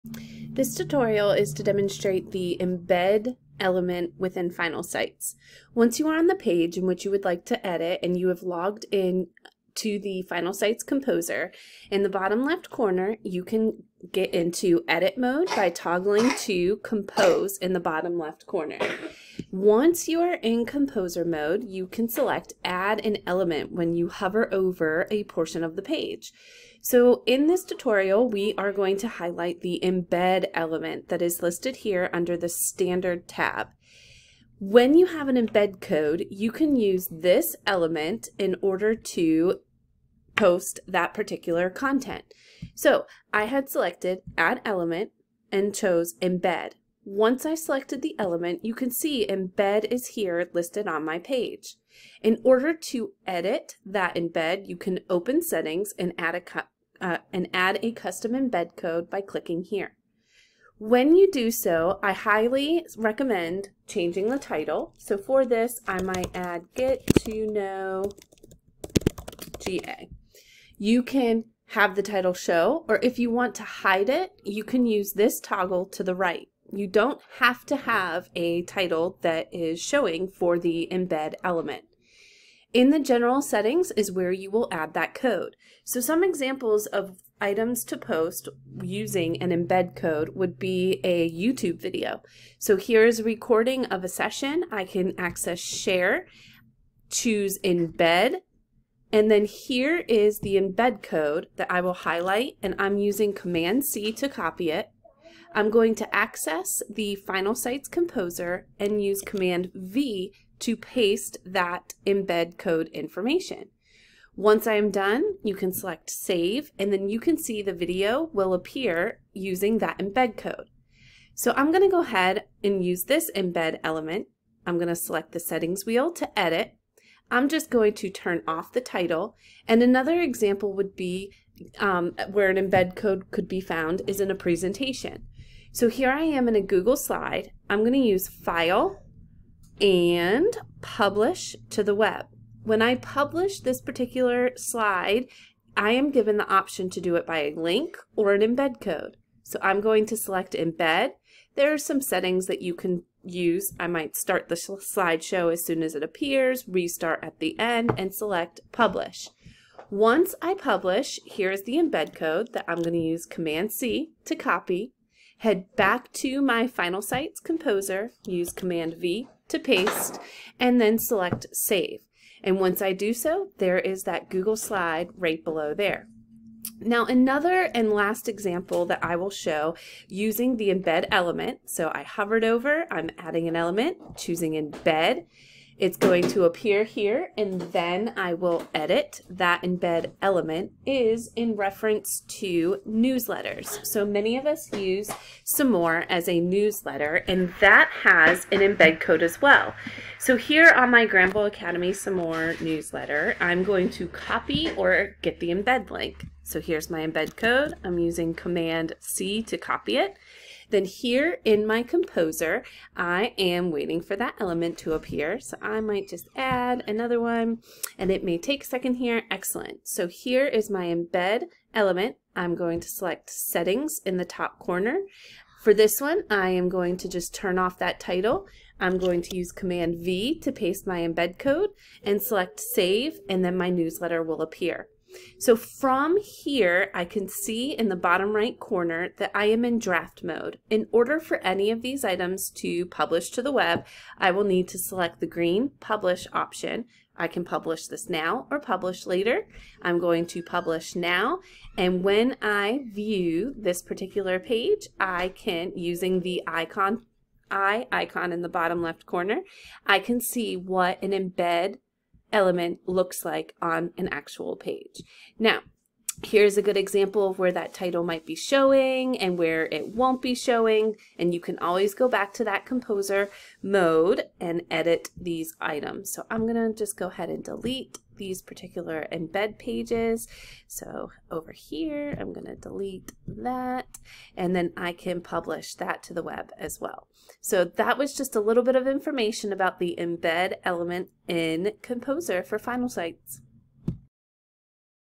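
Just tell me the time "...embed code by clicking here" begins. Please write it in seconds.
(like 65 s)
58 s.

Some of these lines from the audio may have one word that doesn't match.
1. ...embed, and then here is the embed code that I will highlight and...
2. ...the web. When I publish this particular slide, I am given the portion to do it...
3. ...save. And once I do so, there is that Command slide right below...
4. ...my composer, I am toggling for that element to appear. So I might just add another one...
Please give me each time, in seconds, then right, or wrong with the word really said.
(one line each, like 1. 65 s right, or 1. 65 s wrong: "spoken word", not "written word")
1. 97 s right
2. 141 s wrong: "option", not "portion"
3. 171 s wrong: "Google", not "Command"
4. 211 s wrong: "waiting", not "toggling".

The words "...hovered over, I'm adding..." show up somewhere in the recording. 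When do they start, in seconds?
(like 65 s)
182 s.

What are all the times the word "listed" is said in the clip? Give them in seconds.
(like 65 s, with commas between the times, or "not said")
31 s, 50 s.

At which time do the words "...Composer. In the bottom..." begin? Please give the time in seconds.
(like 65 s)
10 s.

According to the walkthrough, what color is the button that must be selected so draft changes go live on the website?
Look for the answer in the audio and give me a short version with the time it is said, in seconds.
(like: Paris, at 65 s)
Green, at 245 s.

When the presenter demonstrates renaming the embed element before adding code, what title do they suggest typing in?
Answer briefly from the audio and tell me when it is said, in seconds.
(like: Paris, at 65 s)
Get to know GA, at 66 s.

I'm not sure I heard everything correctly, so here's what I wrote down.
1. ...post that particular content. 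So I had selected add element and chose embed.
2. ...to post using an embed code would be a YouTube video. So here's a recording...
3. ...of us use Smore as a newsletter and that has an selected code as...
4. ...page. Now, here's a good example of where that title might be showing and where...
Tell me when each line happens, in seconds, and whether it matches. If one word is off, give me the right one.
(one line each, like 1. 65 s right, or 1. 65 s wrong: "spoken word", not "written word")
1. 40 s right
2. 87 s right
3. 194 s wrong: "embed", not "selected"
4. 264 s right.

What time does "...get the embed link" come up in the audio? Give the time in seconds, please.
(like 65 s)
205 s.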